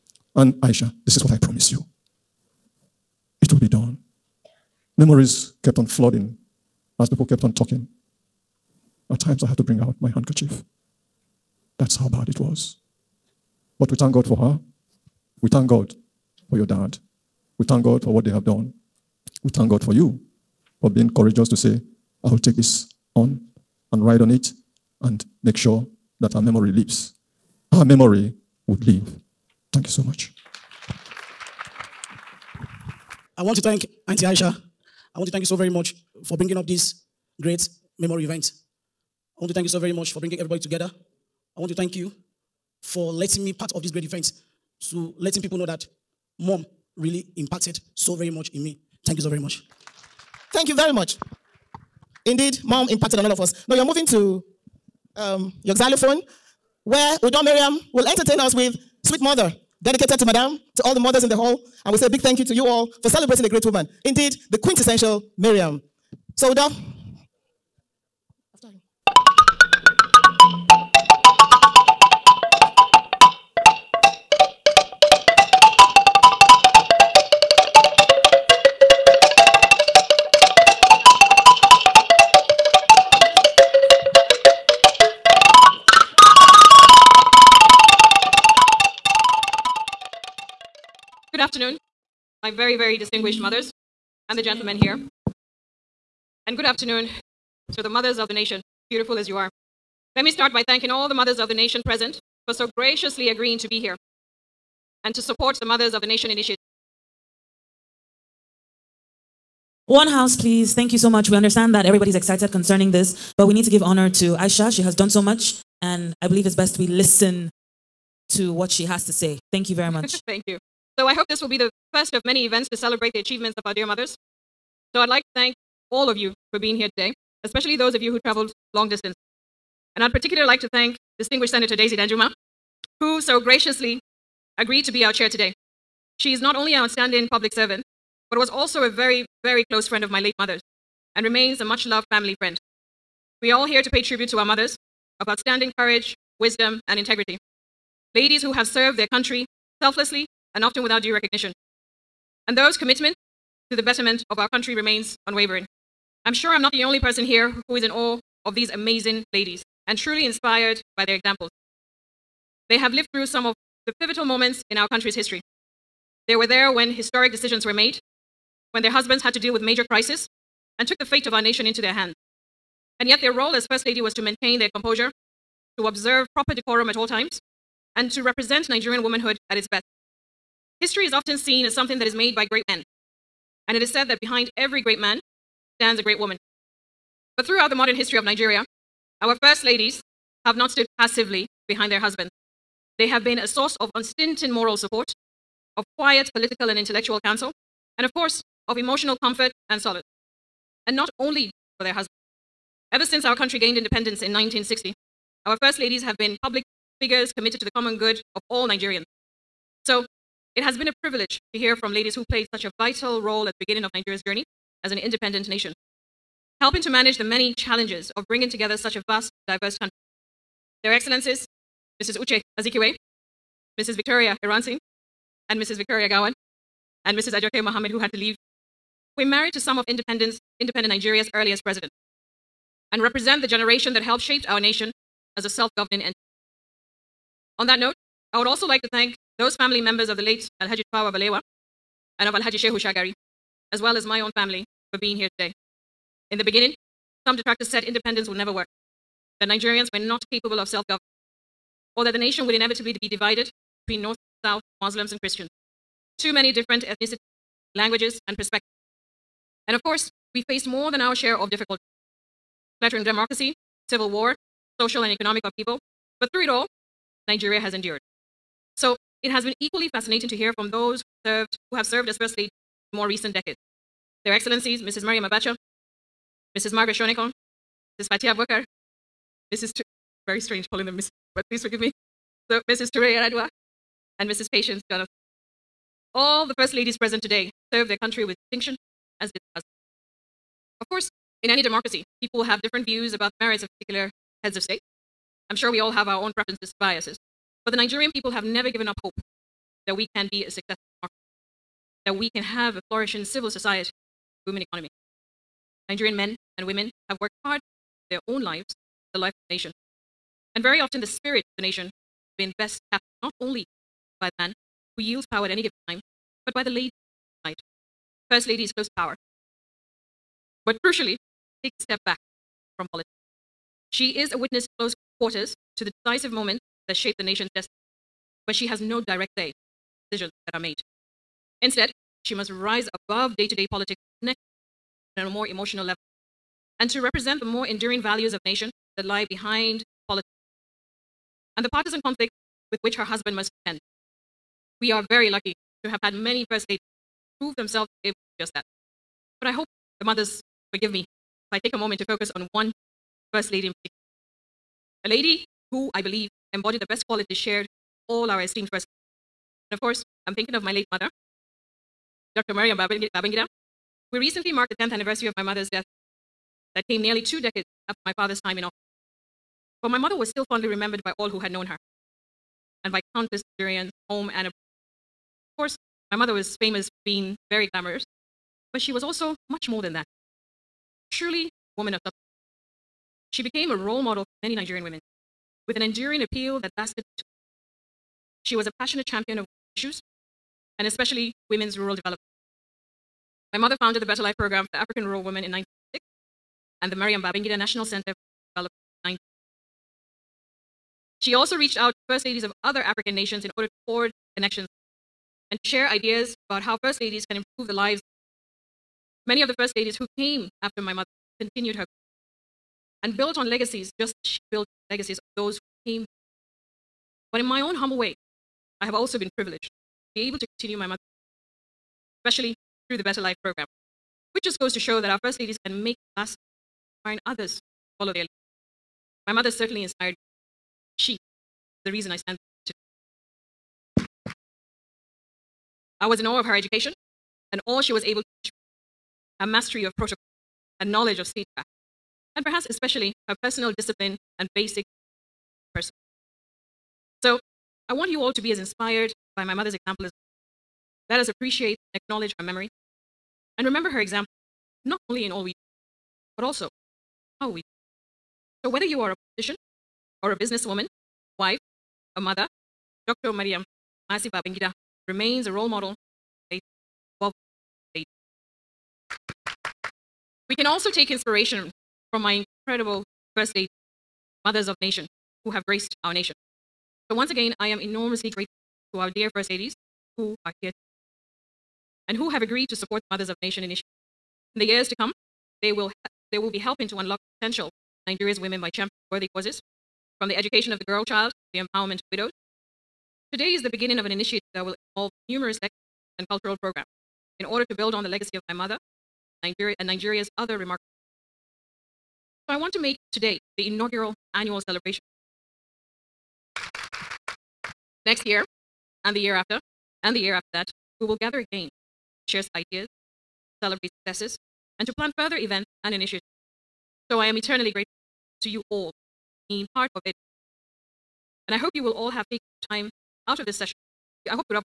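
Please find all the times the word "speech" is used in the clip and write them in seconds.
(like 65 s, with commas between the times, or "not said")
441 s.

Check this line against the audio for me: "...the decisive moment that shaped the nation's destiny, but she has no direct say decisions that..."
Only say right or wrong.
right.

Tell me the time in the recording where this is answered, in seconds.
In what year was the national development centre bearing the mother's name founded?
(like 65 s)
399 s.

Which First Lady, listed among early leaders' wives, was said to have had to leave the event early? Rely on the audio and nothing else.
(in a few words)
Ajoke Mohammed.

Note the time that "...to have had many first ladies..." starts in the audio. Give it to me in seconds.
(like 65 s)
345 s.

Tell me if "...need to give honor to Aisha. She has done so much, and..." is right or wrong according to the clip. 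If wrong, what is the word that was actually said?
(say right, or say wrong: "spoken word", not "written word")
right.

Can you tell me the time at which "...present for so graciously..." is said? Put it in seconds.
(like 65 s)
101 s.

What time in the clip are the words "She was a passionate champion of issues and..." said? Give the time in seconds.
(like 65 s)
388 s.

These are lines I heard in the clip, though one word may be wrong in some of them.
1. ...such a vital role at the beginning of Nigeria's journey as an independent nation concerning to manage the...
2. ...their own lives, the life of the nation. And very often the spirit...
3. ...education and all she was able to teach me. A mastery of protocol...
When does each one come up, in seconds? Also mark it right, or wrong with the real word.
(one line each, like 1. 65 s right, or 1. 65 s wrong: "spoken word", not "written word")
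1. 212 s wrong: "helping", not "concerning"
2. 308 s right
3. 436 s right.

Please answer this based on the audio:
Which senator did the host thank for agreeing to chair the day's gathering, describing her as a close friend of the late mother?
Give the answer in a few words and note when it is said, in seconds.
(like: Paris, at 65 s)
Daisy Danjuma, at 131 s.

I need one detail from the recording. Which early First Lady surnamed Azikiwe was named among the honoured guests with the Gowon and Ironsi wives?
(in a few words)
Uche Azikiwe.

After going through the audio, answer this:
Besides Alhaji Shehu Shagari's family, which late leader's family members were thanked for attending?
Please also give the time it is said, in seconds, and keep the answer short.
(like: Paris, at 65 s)
Tafawa Balewa, at 240 s.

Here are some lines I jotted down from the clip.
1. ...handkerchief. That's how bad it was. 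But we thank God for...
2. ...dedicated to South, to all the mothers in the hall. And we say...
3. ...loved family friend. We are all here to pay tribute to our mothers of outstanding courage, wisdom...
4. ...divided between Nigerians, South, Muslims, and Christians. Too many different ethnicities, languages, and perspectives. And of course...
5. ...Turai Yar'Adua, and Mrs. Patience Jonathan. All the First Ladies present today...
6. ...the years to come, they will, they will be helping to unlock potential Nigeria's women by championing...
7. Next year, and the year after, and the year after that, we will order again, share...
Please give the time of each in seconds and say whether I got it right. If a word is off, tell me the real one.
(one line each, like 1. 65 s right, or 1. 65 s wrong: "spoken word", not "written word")
1. 10 s right
2. 59 s wrong: "Madame", not "South"
3. 141 s right
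4. 253 s wrong: "North", not "Nigerians"
5. 282 s right
6. 484 s right
7. 508 s wrong: "gather", not "order".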